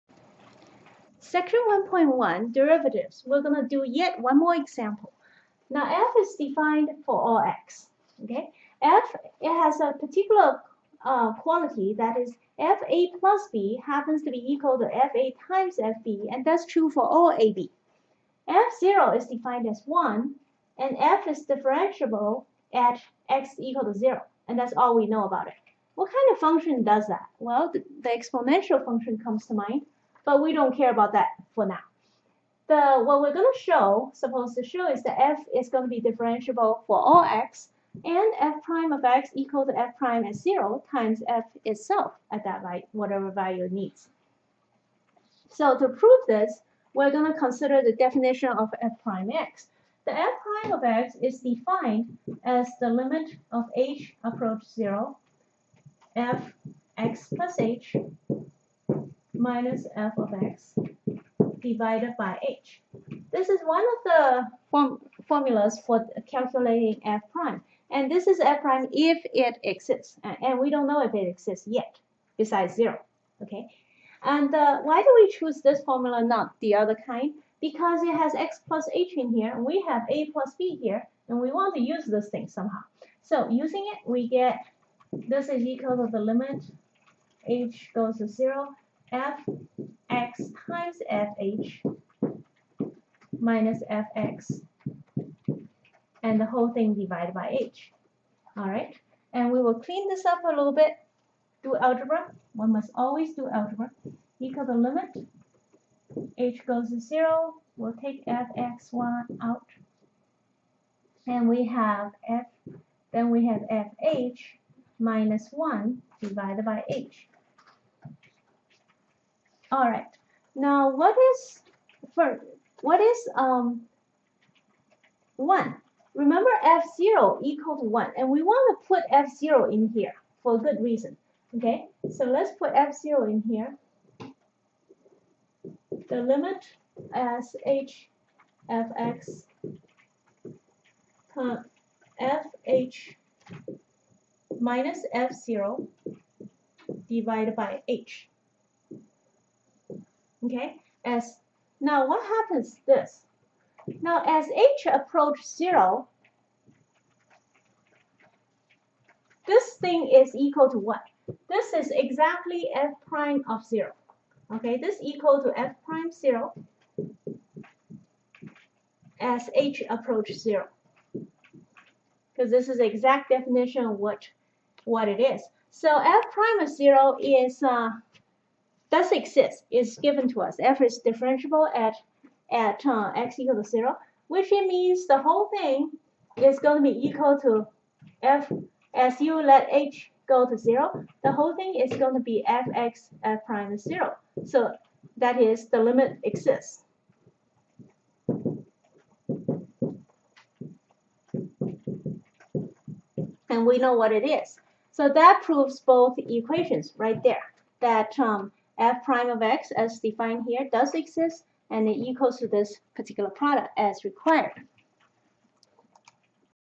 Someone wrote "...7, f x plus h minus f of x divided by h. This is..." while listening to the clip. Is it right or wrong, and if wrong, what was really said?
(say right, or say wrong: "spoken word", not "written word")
wrong: "0", not "7".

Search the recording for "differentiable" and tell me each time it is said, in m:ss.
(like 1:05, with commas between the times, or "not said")
0:21, 0:36, 3:01.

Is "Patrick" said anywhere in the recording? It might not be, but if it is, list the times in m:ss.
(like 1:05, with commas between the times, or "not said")
not said.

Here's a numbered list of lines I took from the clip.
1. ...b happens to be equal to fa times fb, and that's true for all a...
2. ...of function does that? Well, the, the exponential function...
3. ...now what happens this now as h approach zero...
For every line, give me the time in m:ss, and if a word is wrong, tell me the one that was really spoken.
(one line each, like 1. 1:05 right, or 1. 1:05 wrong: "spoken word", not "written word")
1. 0:13 right
2. 0:26 right
3. 2:31 right.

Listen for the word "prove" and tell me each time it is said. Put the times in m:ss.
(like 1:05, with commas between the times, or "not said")
0:45, 3:25.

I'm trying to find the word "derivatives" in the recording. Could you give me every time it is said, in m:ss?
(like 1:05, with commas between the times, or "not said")
0:02.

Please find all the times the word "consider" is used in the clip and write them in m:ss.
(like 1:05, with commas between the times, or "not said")
0:47.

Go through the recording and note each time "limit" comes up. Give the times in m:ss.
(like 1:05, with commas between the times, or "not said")
0:52, 1:26, 1:44, 2:16, 3:15.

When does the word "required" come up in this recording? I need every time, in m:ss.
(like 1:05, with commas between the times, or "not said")
3:34.